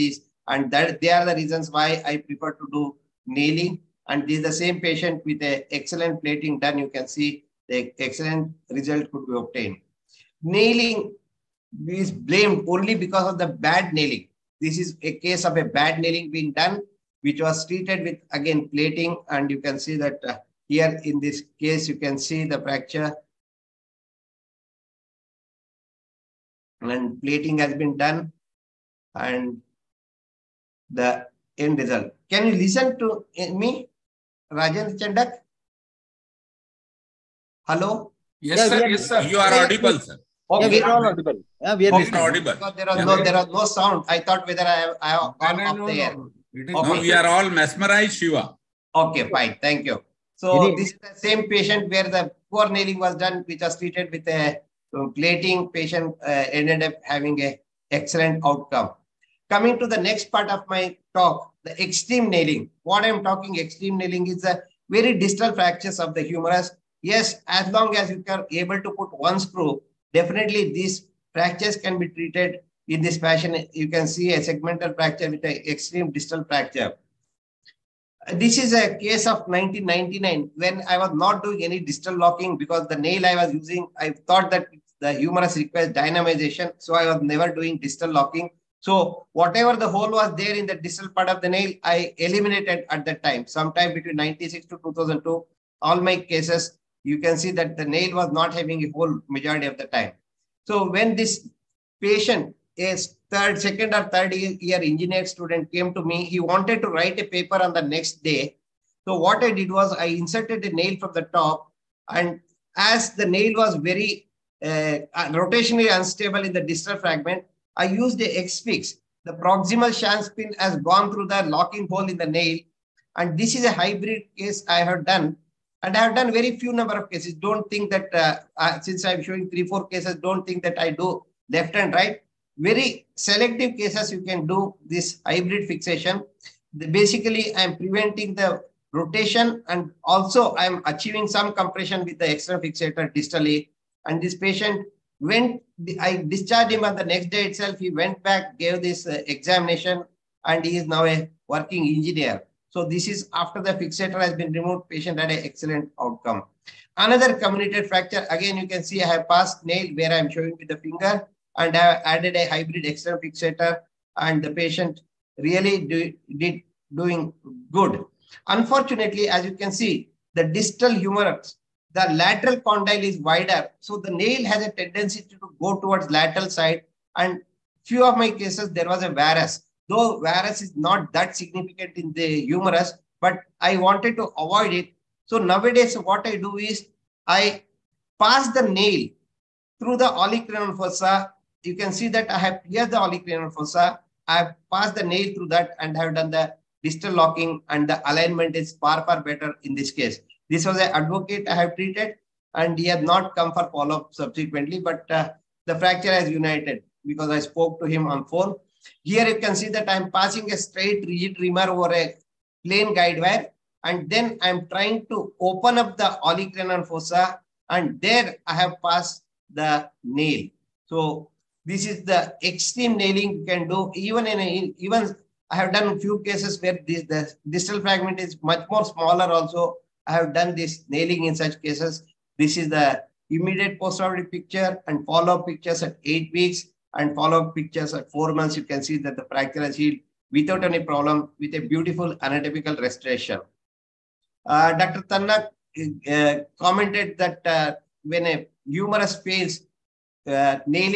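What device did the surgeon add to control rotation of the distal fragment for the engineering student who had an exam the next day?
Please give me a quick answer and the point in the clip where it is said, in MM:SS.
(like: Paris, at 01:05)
X-fix, at 01:58.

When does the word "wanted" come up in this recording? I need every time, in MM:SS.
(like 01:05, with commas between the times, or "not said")
01:46, 03:03.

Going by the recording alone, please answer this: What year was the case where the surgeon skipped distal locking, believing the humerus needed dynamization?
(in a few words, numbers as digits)
1999.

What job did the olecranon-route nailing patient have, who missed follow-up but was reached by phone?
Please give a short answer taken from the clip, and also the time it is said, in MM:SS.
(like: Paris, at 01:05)
Advocate, at 03:20.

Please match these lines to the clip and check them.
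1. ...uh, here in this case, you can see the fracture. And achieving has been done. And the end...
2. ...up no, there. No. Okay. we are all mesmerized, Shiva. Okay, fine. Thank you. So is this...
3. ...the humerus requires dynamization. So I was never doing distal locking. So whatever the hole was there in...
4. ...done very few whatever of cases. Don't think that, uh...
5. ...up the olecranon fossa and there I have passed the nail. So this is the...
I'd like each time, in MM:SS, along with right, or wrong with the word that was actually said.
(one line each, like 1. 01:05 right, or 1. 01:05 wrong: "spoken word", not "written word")
1. 00:20 wrong: "plating", not "achieving"
2. 00:45 right
3. 01:24 right
4. 02:06 wrong: "number", not "whatever"
5. 03:35 right.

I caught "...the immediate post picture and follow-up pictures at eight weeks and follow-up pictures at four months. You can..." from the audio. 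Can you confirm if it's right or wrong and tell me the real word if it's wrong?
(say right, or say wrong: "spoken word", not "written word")
right.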